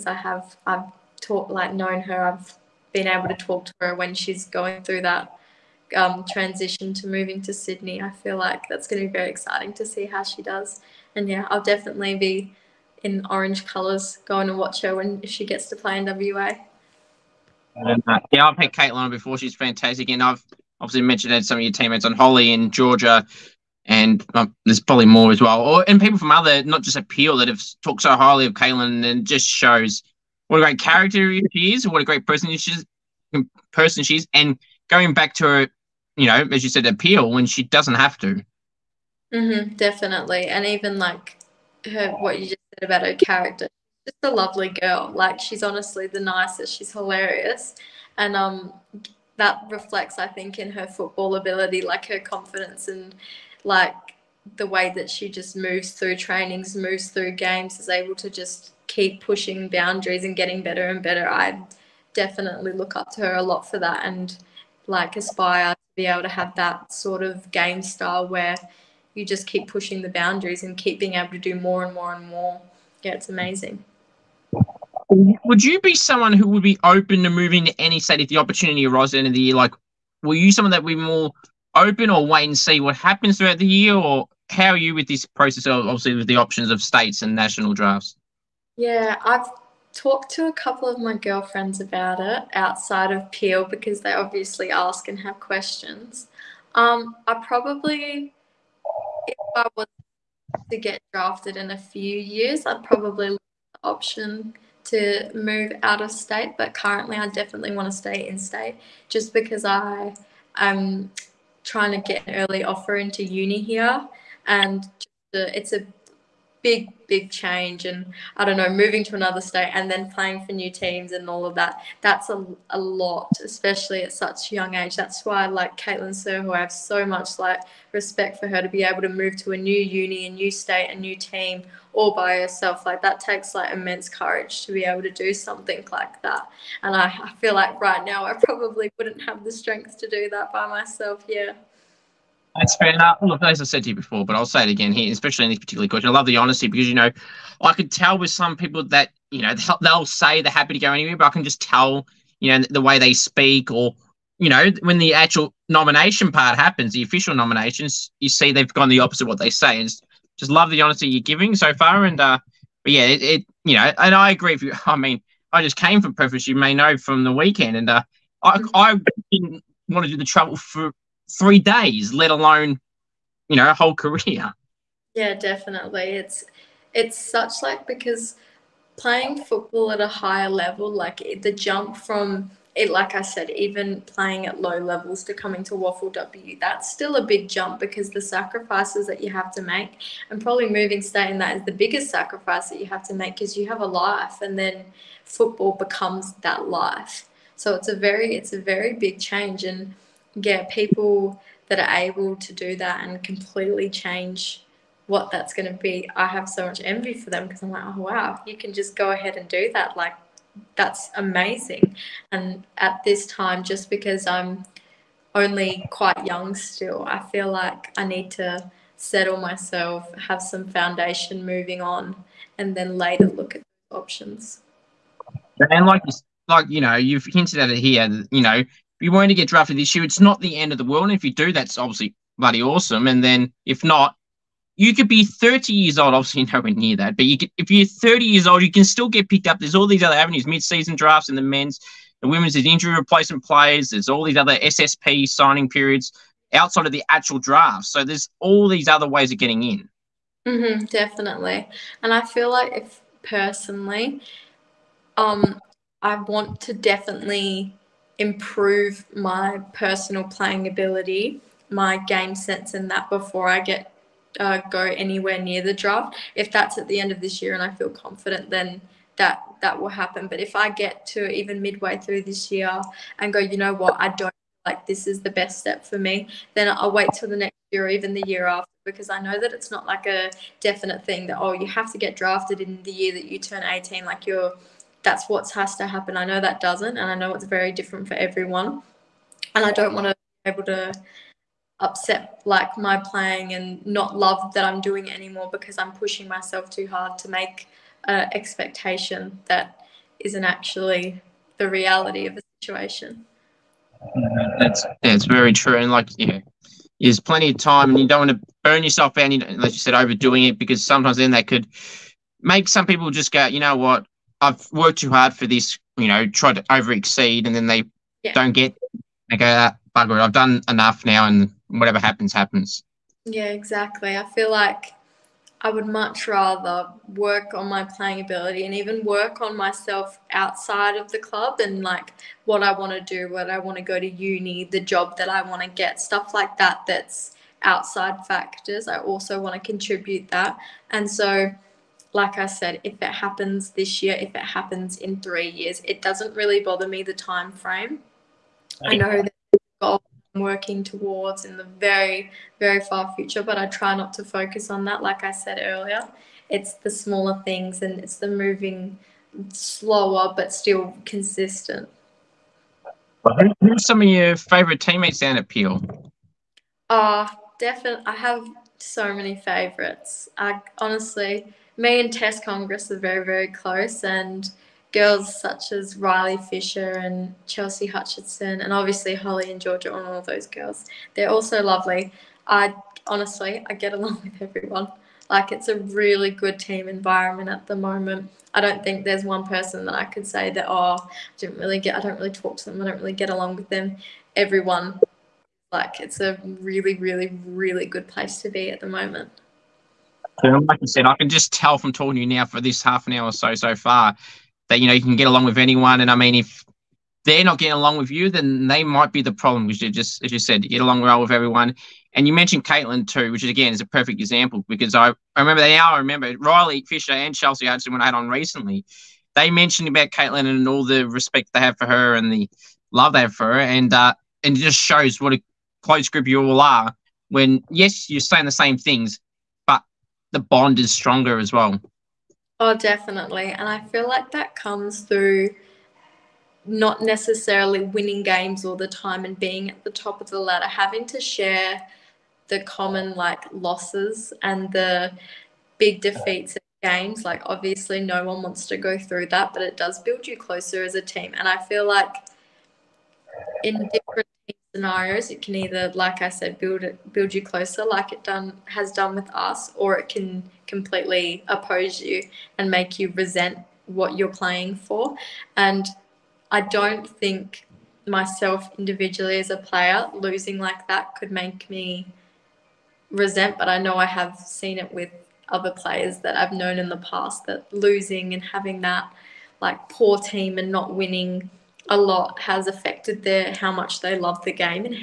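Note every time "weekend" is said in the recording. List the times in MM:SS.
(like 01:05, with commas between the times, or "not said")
02:47.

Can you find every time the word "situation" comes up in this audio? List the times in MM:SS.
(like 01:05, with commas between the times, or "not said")
05:02.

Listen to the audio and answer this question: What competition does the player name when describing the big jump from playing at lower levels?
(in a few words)
WAFLW.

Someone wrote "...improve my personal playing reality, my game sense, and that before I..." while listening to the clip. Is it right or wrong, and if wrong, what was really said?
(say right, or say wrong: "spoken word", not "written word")
wrong: "ability", not "reality".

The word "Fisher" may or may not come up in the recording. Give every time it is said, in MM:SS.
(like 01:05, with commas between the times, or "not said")
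06:16, 06:56.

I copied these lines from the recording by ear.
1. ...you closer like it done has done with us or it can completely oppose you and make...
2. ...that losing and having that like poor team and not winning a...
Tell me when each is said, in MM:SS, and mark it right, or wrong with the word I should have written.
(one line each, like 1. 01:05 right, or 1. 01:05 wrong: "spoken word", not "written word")
1. 07:37 right
2. 07:57 right.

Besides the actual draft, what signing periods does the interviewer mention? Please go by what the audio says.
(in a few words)
SSP.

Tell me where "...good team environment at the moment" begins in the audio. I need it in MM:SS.
06:26.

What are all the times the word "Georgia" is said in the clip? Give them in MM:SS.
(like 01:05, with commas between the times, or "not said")
00:22, 06:19.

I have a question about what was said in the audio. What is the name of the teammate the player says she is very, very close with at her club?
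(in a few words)
Tess Congress.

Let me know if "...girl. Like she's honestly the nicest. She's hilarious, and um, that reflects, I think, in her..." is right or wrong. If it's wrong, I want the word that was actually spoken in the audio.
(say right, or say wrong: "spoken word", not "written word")
right.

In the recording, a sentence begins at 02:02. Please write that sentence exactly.
That's a, a lot, especially at such a young age.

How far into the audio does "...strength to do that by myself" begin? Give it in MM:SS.
02:19.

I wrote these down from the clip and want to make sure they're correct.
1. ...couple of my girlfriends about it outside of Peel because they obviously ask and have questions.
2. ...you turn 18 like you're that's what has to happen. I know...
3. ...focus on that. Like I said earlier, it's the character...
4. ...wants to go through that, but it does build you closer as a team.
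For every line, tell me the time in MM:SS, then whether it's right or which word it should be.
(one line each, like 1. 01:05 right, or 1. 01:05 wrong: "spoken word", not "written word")
1. 01:30 right
2. 04:43 right
3. 05:54 wrong: "smaller", not "character"
4. 07:28 right.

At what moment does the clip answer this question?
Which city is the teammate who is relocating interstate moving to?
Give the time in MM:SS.
00:07.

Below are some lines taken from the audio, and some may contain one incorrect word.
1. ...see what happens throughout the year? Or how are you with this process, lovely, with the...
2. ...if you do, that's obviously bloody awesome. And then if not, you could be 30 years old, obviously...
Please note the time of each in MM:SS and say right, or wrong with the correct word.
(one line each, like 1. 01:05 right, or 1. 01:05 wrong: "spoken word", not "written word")
1. 01:22 wrong: "obviously", not "lovely"
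2. 03:51 right.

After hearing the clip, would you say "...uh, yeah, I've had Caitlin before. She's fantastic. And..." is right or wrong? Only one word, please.
right.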